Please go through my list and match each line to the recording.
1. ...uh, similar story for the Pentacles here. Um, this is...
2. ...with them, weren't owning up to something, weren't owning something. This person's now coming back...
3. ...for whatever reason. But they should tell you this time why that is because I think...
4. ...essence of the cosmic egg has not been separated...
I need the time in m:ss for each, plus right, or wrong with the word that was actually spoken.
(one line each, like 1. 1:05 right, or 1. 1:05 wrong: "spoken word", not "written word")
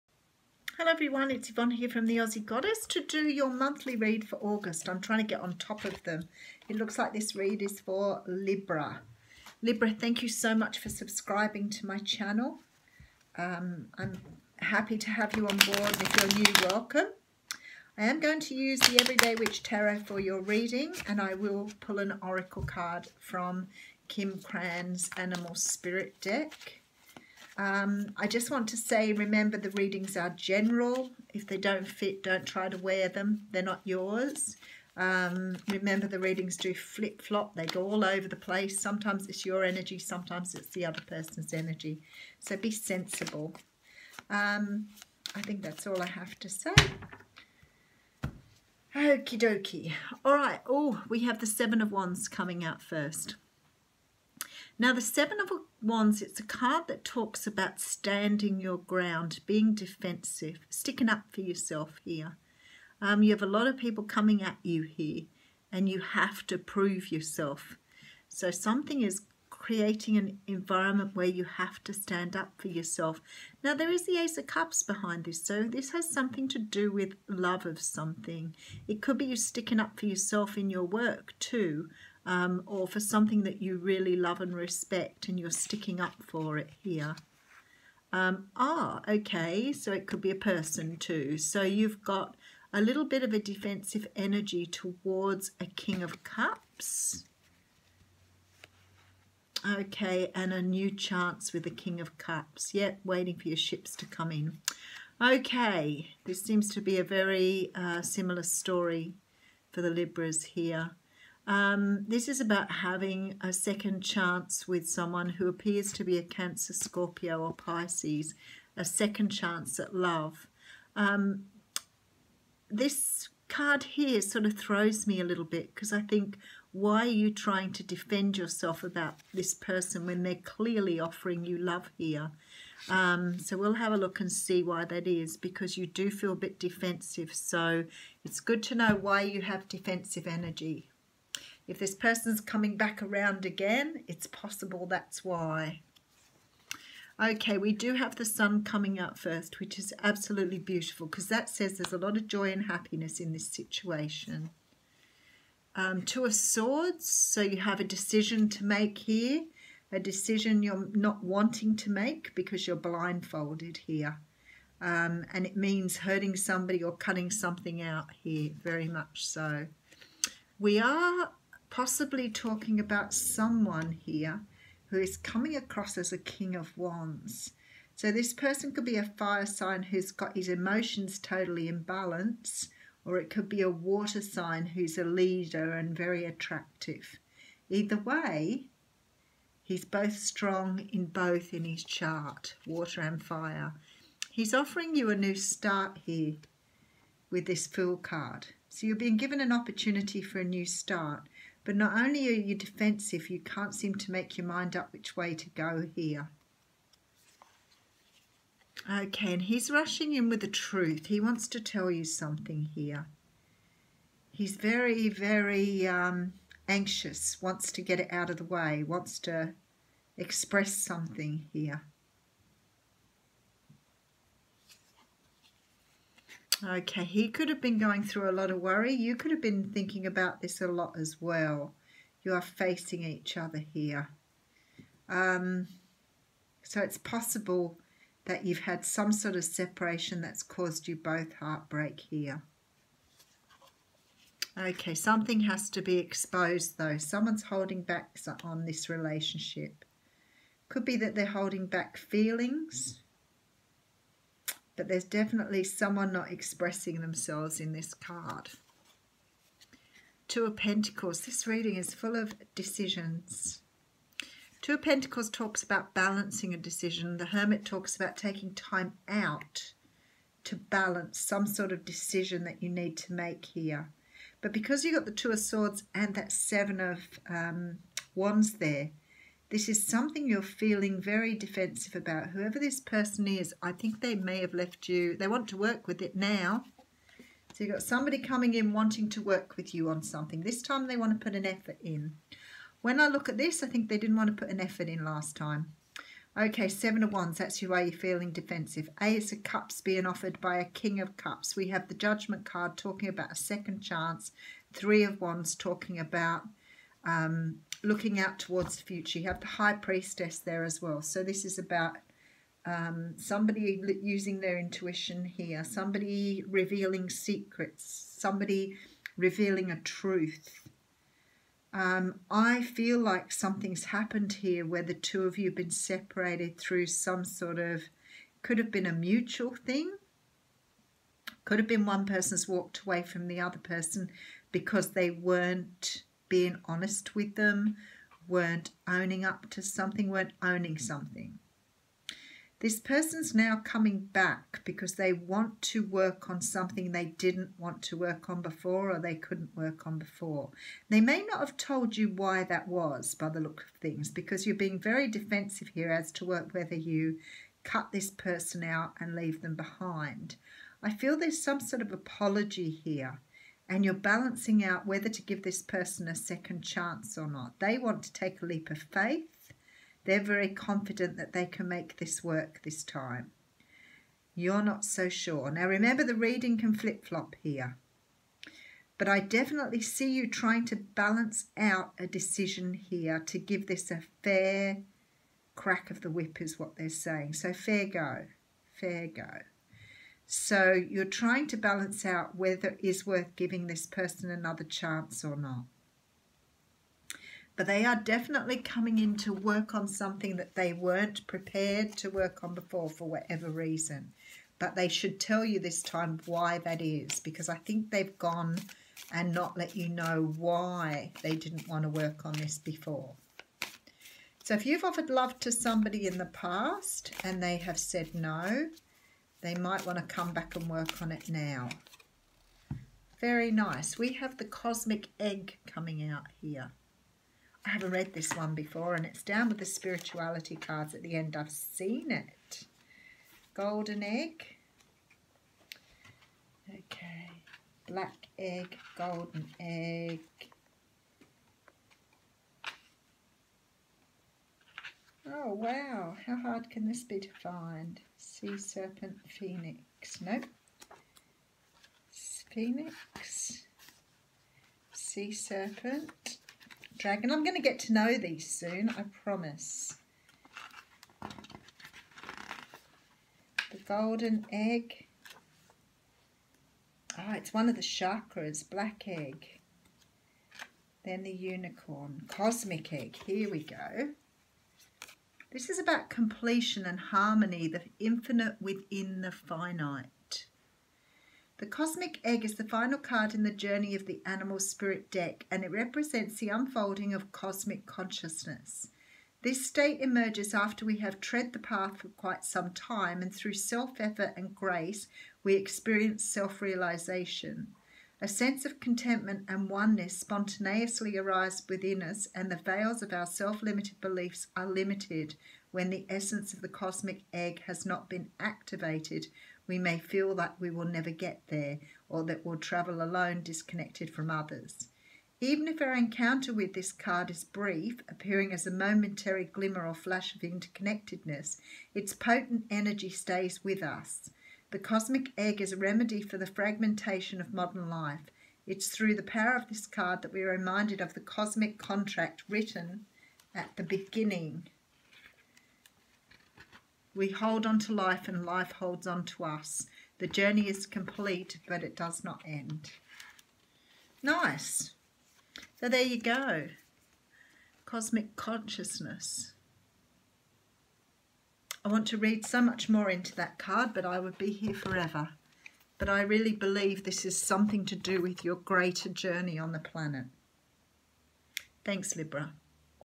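1. 1:47 wrong: "Libras", not "Pentacles"
2. 5:37 right
3. 6:42 right
4. 8:26 wrong: "activated", not "separated".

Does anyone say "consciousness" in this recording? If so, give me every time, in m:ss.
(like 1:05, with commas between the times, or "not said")
8:07, 9:08.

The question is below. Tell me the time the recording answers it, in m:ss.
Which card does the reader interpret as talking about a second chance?
5:01.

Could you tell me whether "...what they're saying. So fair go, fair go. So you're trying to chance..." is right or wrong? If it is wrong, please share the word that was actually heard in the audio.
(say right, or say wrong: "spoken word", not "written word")
wrong: "balance", not "chance".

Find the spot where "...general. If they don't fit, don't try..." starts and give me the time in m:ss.
0:30.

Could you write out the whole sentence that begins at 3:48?
You could have been thinking about this a lot as well.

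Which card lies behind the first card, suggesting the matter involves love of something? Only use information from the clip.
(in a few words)
Ace of Cups.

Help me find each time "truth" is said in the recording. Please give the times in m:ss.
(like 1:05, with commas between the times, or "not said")
3:30, 5:19.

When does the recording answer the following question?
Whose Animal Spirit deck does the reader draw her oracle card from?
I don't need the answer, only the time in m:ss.
0:24.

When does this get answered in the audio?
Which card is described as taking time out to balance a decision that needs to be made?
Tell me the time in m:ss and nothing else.
4:27.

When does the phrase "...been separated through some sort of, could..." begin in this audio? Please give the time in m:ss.
5:25.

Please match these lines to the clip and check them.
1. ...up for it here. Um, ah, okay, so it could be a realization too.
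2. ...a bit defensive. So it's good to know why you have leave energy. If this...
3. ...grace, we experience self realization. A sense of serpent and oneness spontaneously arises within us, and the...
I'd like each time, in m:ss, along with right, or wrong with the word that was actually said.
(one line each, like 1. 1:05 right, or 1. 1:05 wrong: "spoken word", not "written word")
1. 1:25 wrong: "person", not "realization"
2. 2:16 wrong: "defensive", not "leave"
3. 8:14 wrong: "contentment", not "serpent".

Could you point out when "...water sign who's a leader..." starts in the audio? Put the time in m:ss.
3:03.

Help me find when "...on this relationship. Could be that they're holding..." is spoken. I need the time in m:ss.
4:08.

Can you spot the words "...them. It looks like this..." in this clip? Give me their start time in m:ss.
0:06.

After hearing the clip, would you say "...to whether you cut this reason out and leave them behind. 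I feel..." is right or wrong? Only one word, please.
wrong.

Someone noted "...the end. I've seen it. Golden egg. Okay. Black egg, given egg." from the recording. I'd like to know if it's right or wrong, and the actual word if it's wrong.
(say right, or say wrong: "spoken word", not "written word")
wrong: "golden", not "given".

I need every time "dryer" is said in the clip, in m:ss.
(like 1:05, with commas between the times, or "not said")
not said.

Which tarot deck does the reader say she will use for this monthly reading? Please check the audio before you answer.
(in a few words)
Everyday Witch Tarot.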